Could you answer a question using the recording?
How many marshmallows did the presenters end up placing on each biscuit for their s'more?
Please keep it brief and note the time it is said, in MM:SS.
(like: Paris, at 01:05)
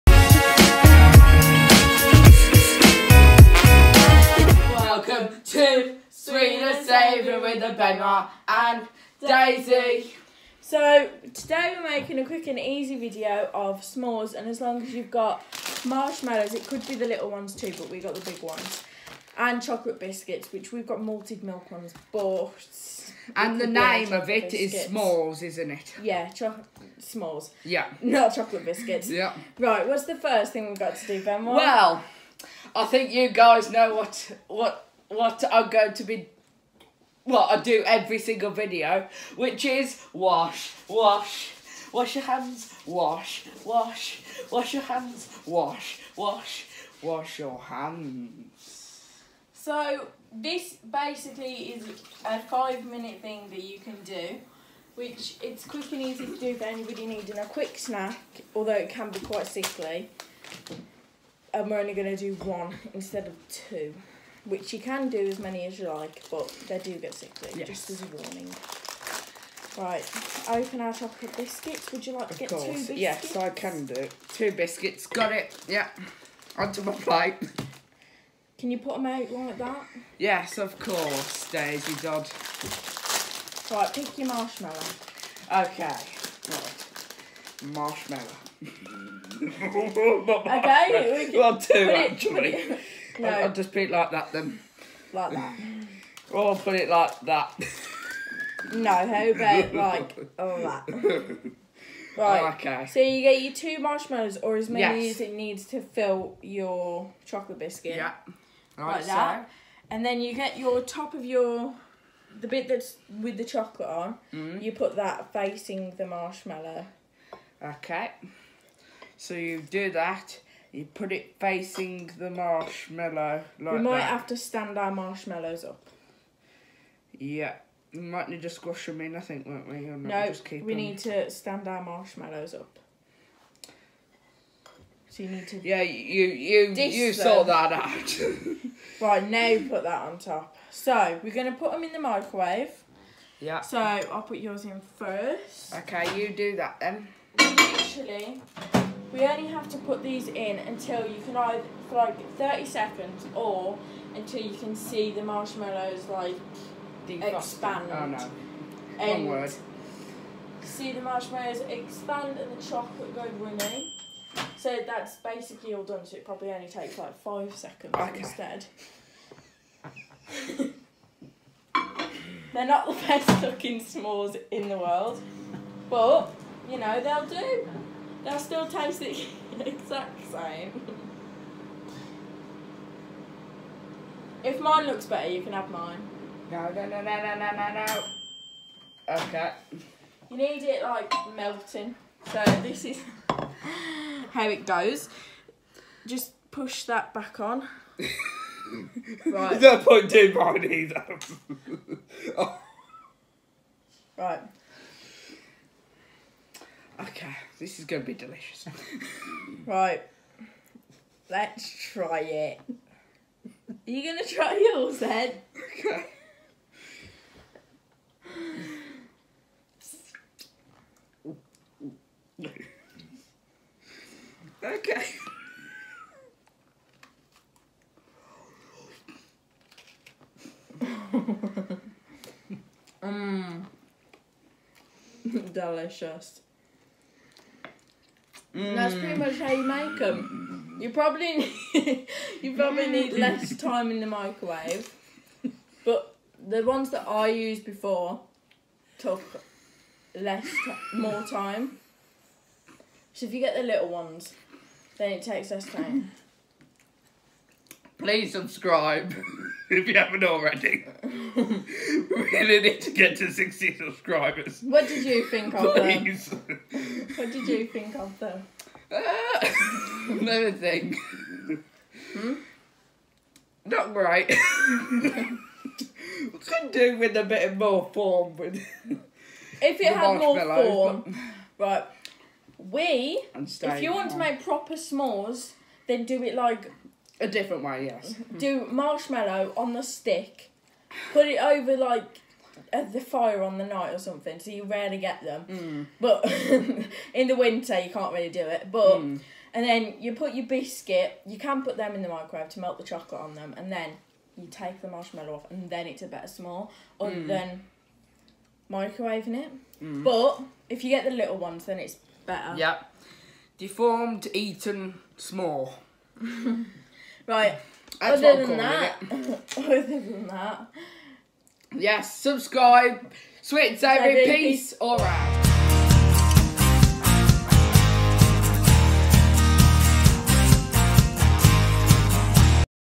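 2, at 01:31.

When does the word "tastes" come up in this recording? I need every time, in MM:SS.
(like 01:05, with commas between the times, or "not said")
02:58.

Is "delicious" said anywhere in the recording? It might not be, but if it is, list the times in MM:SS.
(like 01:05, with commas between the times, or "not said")
03:28, 03:55.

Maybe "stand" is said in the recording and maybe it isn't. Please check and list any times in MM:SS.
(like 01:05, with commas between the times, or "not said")
02:04, 02:11.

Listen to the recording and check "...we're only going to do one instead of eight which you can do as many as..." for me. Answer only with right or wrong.
wrong.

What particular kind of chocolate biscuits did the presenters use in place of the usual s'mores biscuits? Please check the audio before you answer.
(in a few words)
malted milk.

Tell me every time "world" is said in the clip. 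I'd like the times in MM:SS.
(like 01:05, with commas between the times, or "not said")
02:54.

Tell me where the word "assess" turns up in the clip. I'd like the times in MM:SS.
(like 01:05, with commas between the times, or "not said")
not said.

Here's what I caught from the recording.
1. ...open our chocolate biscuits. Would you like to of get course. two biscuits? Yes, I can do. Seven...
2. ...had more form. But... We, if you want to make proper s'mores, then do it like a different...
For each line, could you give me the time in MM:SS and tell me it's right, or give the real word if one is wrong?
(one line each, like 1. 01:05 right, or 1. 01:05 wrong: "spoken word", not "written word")
1. 01:10 wrong: "Two", not "Seven"
2. 04:39 right.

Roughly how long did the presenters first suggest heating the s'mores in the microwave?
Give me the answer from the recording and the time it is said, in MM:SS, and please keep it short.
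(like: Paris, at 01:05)
30 seconds, at 02:32.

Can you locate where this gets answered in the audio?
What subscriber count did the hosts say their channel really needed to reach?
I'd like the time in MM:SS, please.
04:23.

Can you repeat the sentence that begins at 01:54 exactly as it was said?
you put that facing the marshmallow.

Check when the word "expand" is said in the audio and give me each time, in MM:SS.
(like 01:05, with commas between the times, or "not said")
02:37, 02:41.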